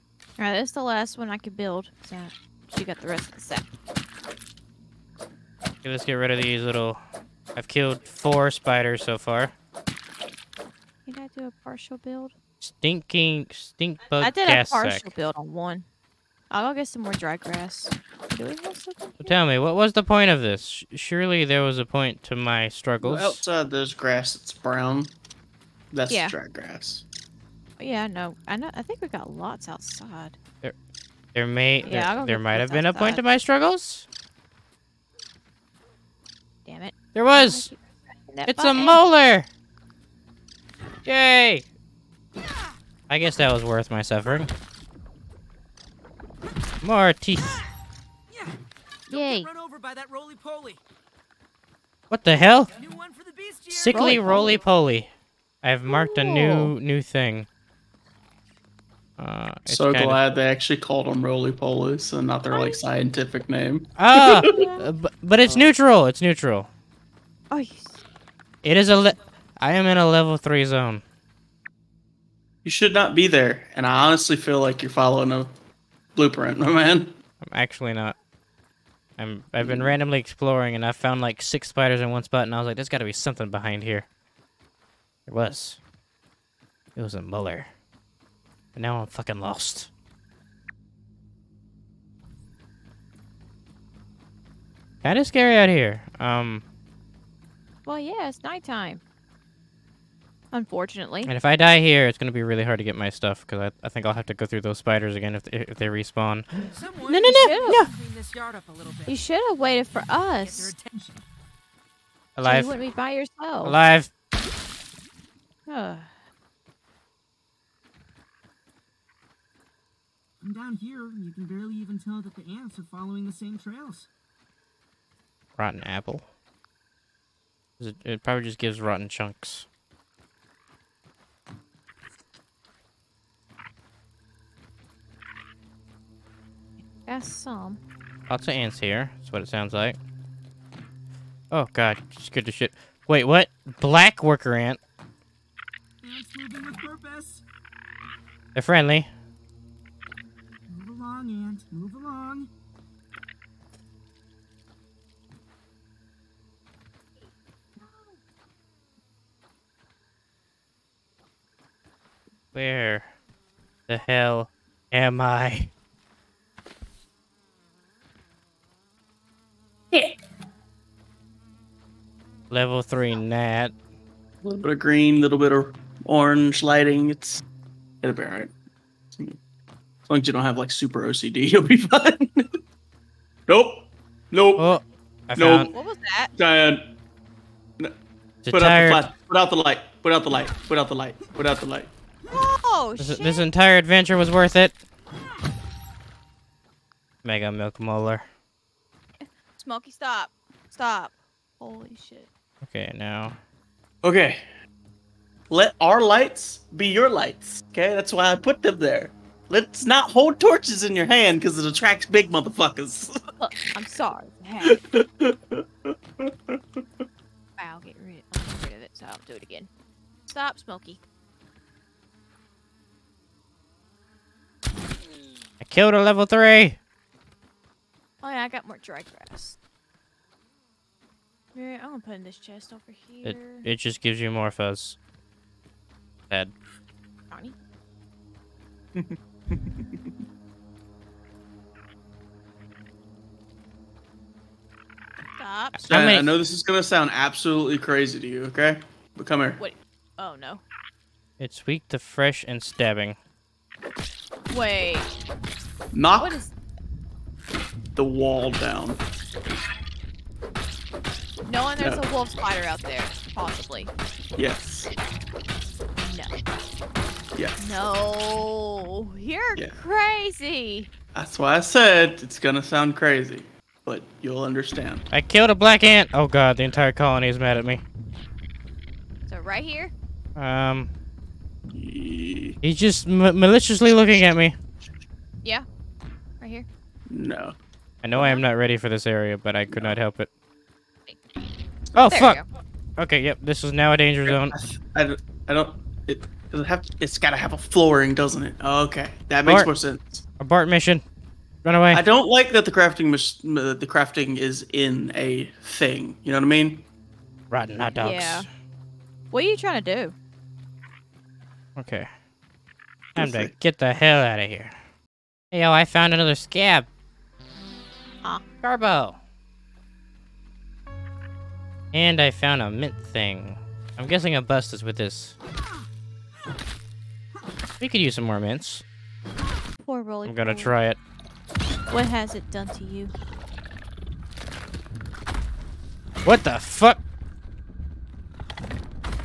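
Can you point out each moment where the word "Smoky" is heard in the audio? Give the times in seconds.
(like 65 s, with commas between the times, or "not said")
199 s, 220 s.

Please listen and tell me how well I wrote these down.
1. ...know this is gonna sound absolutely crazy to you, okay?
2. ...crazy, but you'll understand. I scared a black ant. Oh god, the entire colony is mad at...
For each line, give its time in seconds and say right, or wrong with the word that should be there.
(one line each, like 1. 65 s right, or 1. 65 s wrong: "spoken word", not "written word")
1. 246 s right
2. 272 s wrong: "killed", not "scared".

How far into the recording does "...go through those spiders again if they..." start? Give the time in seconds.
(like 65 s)
104 s.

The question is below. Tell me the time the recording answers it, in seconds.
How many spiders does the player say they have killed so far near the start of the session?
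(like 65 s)
8 s.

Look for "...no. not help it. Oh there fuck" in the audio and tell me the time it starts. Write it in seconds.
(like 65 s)
289 s.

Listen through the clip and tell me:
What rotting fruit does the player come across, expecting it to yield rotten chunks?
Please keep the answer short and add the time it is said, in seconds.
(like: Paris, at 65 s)
Rotten apple, at 125 s.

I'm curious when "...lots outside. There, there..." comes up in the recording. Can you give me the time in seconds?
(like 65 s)
29 s.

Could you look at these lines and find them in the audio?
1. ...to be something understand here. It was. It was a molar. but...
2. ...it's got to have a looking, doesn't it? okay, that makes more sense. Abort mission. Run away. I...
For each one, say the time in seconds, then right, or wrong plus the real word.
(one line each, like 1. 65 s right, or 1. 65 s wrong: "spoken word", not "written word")
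1. 82 s wrong: "behind", not "understand"
2. 297 s wrong: "flooring", not "looking".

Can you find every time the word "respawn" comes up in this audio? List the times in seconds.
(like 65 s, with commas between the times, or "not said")
105 s.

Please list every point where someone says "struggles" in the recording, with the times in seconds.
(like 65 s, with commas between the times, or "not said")
22 s, 33 s.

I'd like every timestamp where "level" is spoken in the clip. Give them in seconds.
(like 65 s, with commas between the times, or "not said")
70 s, 172 s, 226 s.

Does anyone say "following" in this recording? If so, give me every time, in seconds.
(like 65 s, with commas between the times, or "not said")
74 s, 122 s.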